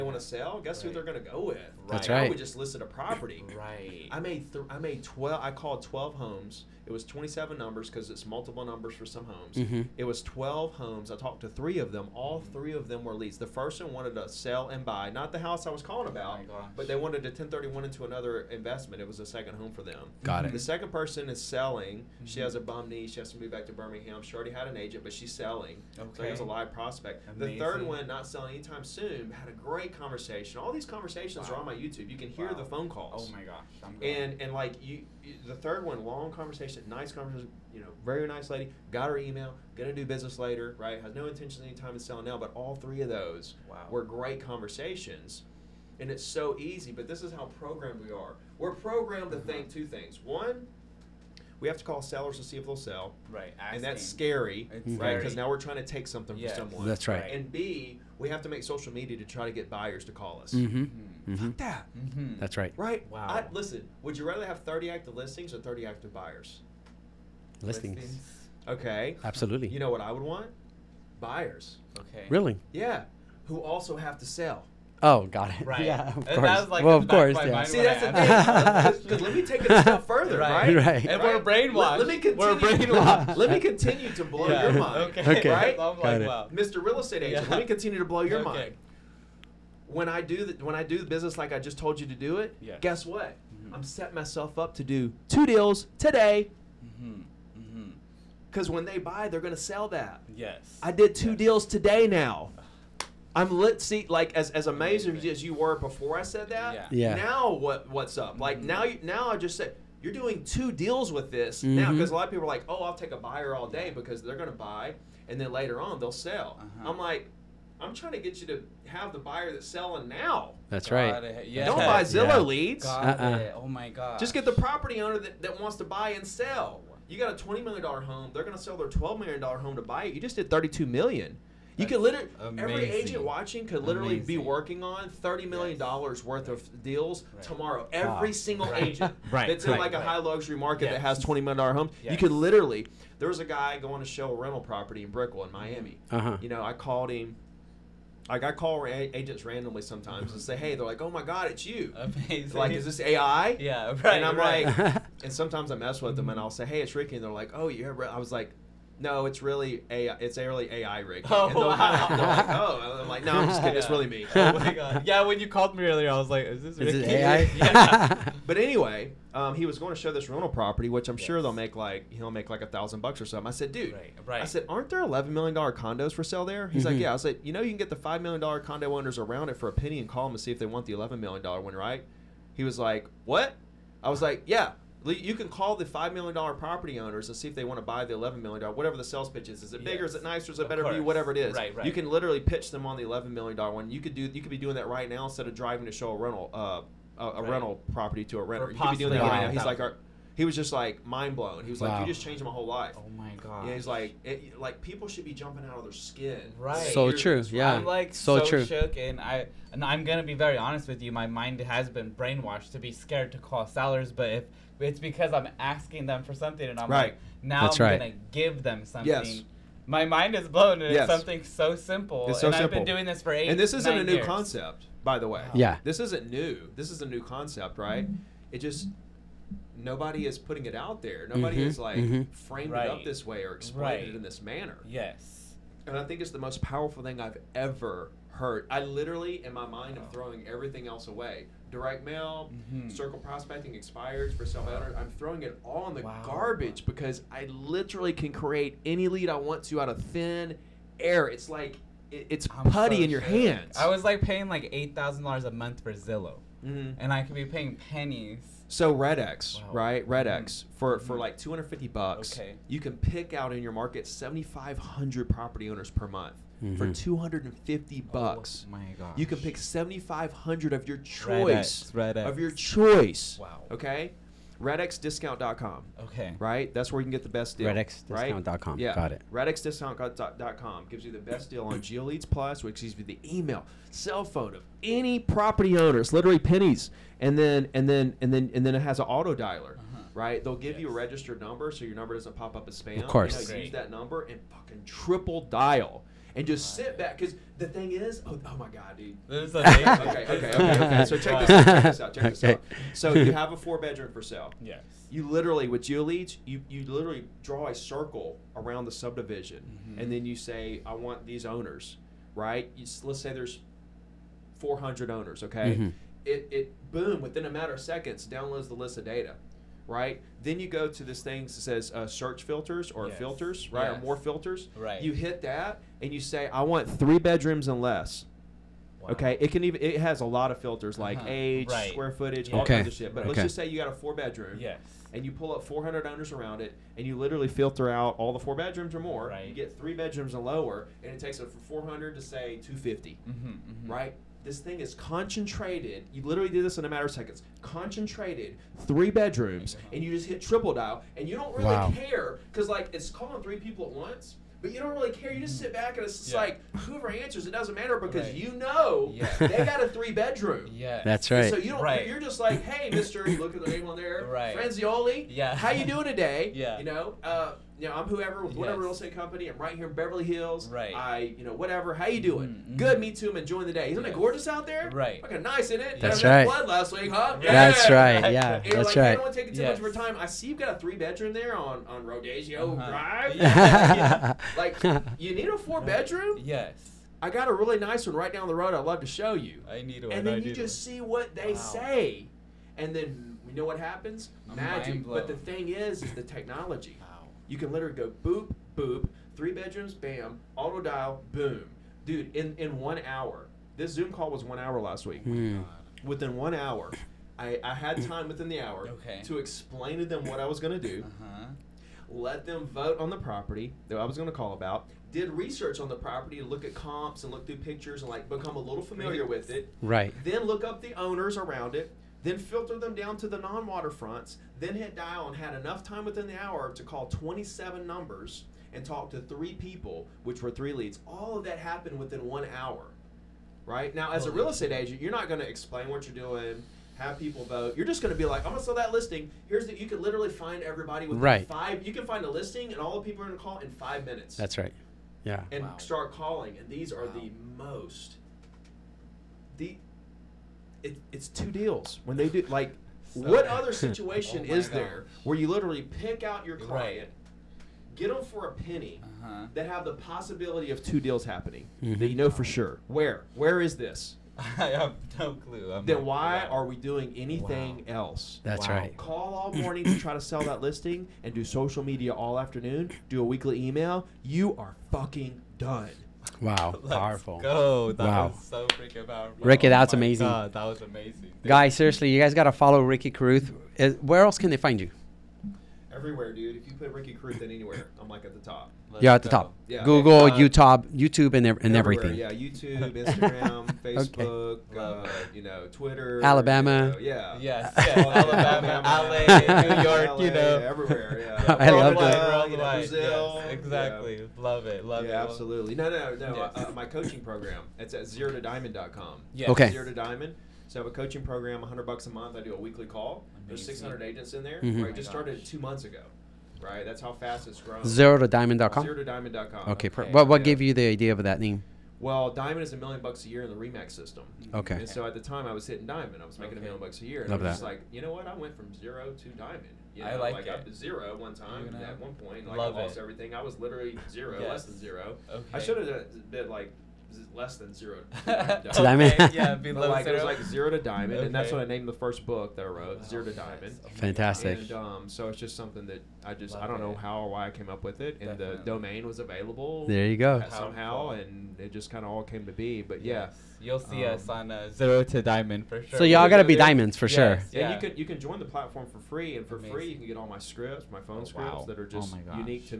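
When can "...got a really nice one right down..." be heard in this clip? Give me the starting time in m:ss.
6:27.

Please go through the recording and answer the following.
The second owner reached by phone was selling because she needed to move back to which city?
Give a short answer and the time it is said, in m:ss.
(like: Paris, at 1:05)
Birmingham, at 0:23.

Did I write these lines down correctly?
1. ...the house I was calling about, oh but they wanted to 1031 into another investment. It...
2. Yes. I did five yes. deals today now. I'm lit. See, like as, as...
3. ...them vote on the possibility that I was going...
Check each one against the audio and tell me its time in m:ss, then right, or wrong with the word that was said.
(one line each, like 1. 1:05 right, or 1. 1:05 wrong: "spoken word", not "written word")
1. 0:15 right
2. 1:40 wrong: "two", not "five"
3. 6:52 wrong: "property", not "possibility".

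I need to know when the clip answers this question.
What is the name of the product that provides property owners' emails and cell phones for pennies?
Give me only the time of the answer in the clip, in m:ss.
4:41.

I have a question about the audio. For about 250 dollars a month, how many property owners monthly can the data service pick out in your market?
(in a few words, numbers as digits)
7,500.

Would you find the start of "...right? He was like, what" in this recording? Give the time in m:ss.
3:01.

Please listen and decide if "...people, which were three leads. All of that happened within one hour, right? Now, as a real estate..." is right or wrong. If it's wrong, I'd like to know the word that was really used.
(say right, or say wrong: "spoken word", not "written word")
right.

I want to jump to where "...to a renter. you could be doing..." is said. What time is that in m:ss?
3:18.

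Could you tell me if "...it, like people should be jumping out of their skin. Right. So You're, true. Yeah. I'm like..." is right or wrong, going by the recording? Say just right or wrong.
right.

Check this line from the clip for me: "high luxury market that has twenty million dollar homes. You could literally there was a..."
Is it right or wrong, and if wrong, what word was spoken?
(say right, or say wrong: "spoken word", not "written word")
right.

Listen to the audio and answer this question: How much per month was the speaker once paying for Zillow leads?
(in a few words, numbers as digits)
$8,000.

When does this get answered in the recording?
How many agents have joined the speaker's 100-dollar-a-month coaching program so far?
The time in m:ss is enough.
8:33.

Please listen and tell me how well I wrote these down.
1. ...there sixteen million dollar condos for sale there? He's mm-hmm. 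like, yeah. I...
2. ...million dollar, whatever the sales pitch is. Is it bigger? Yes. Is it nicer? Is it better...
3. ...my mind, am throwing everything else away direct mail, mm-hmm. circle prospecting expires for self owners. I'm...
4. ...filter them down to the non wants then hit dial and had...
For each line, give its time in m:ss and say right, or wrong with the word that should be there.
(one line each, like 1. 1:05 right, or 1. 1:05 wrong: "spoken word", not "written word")
1. 2:54 wrong: "eleven", not "sixteen"
2. 3:08 right
3. 3:59 right
4. 7:02 wrong: "waterfronts", not "wants".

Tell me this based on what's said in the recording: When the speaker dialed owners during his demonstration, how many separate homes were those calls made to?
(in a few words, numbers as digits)
12.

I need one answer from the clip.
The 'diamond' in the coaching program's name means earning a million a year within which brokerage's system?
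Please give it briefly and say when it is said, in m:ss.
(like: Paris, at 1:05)
RE/MAX, at 8:43.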